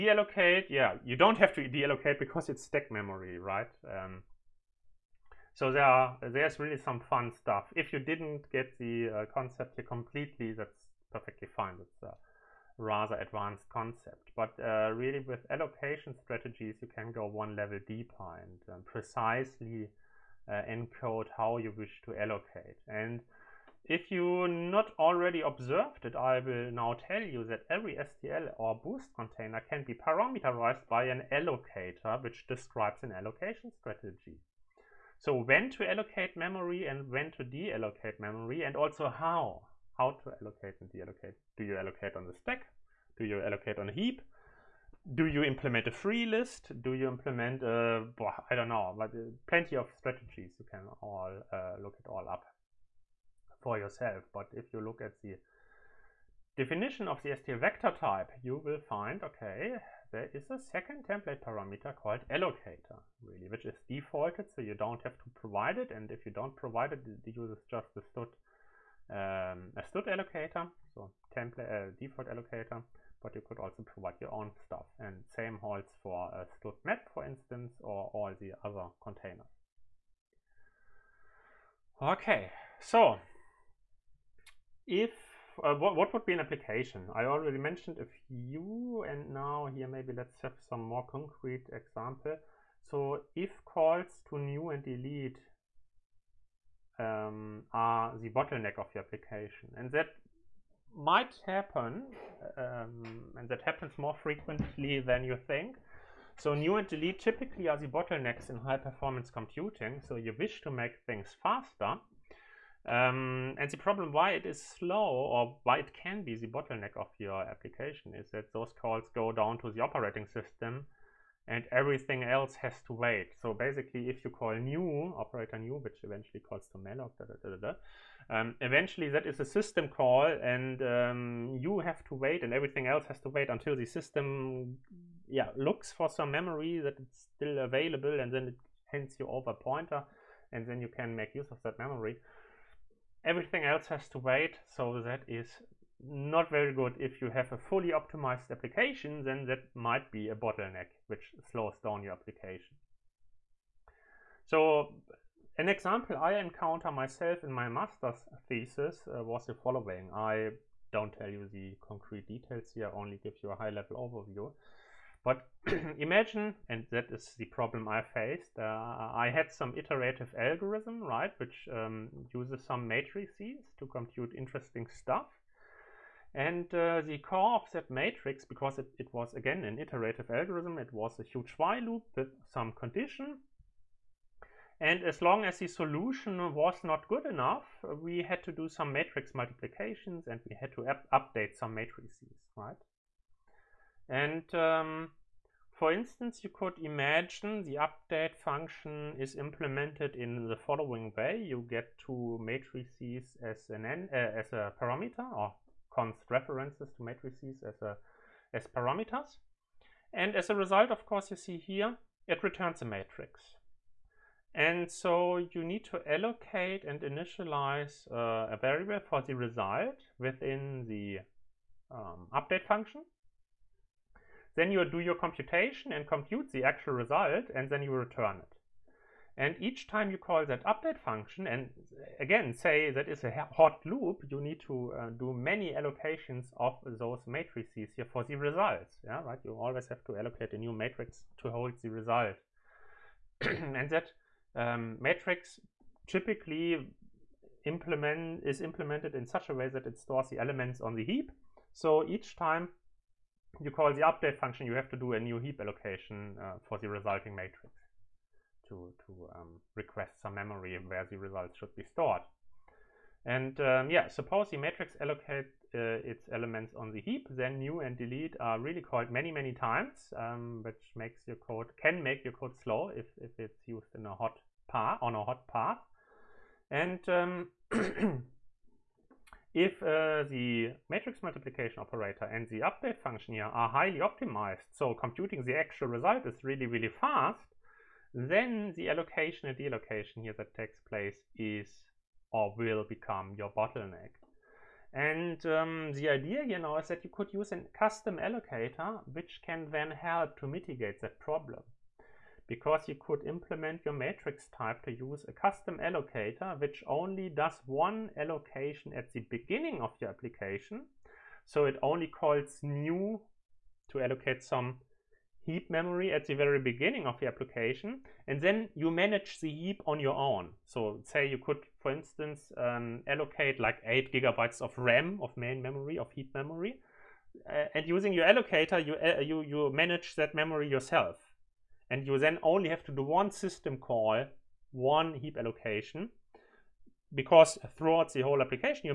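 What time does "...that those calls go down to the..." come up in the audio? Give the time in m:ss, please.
1:58.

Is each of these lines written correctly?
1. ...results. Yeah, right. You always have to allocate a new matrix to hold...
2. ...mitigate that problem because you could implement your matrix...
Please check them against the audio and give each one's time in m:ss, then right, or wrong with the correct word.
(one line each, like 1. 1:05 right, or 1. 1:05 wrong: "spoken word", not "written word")
1. 3:58 right
2. 5:00 right.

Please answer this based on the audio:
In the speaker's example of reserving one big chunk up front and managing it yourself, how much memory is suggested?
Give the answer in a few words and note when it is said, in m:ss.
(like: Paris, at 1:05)
8 gigabytes, at 5:23.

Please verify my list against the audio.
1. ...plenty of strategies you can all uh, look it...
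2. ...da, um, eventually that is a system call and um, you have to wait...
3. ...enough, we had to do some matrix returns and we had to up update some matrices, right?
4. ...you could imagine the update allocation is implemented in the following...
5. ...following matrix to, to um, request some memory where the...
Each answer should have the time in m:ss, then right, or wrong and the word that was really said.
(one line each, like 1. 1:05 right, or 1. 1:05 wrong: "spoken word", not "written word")
1. 0:49 right
2. 2:07 right
3. 3:07 wrong: "multiplications", not "returns"
4. 3:16 wrong: "function", not "allocation"
5. 4:16 wrong: "resulting", not "following".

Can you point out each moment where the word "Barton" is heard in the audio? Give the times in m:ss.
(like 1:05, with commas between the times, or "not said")
not said.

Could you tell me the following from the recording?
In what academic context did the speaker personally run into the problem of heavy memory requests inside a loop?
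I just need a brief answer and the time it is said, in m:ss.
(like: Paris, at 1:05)
master's thesis, at 2:37.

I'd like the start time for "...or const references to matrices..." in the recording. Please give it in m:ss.
3:25.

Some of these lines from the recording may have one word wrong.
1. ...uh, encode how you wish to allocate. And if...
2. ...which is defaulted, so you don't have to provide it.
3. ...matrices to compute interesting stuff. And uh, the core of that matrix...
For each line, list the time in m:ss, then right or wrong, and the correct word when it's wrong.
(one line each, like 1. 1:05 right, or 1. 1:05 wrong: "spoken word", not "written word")
1. 0:20 right
2. 1:03 right
3. 2:52 right.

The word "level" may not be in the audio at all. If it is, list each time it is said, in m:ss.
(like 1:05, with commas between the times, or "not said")
0:17, 2:43.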